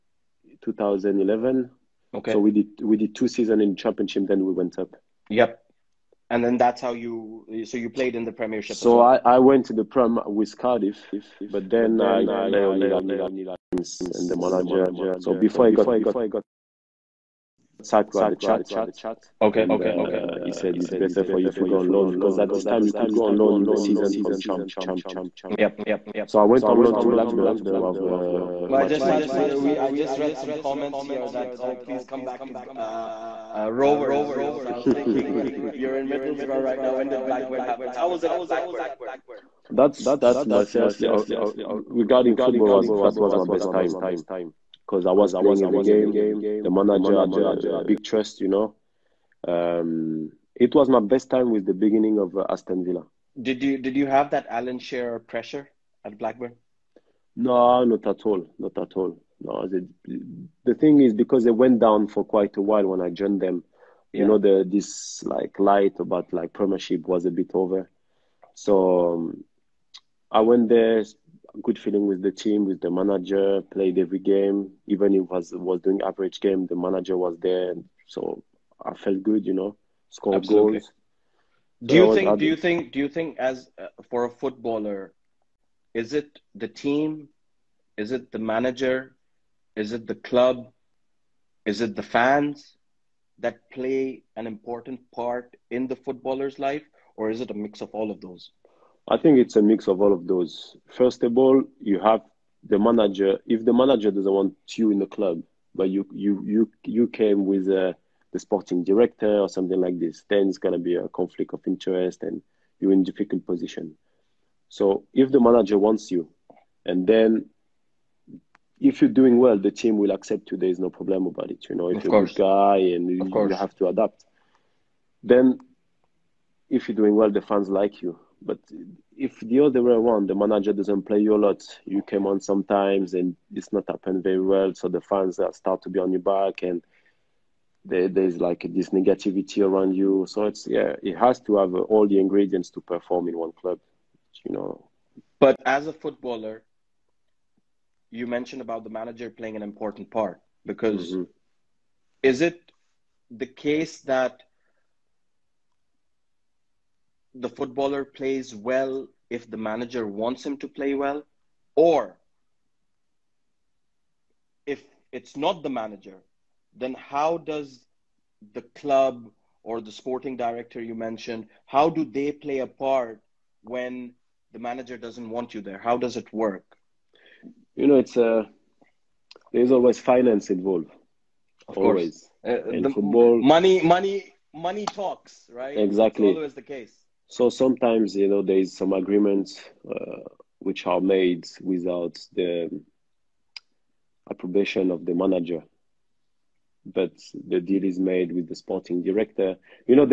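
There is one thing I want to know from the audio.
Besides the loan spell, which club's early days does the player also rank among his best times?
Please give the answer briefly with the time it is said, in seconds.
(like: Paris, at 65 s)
Aston Villa, at 52 s.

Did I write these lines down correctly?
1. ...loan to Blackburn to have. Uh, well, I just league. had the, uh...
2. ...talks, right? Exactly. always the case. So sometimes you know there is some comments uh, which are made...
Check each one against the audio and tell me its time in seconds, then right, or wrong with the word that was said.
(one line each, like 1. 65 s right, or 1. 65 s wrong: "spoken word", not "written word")
1. 26 s right
2. 184 s wrong: "agreements", not "comments".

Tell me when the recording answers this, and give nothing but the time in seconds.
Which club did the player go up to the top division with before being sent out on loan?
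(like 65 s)
10 s.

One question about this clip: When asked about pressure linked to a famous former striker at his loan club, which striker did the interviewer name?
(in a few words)
Alan Shearer.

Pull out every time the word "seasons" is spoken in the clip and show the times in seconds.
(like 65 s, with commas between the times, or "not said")
3 s, 23 s.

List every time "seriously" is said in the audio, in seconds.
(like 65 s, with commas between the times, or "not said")
40 s.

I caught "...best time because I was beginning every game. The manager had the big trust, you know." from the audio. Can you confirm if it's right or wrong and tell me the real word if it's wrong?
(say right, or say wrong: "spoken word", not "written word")
wrong: "playing", not "beginning".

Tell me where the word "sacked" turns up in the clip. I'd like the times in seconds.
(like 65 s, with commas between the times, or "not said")
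17 s.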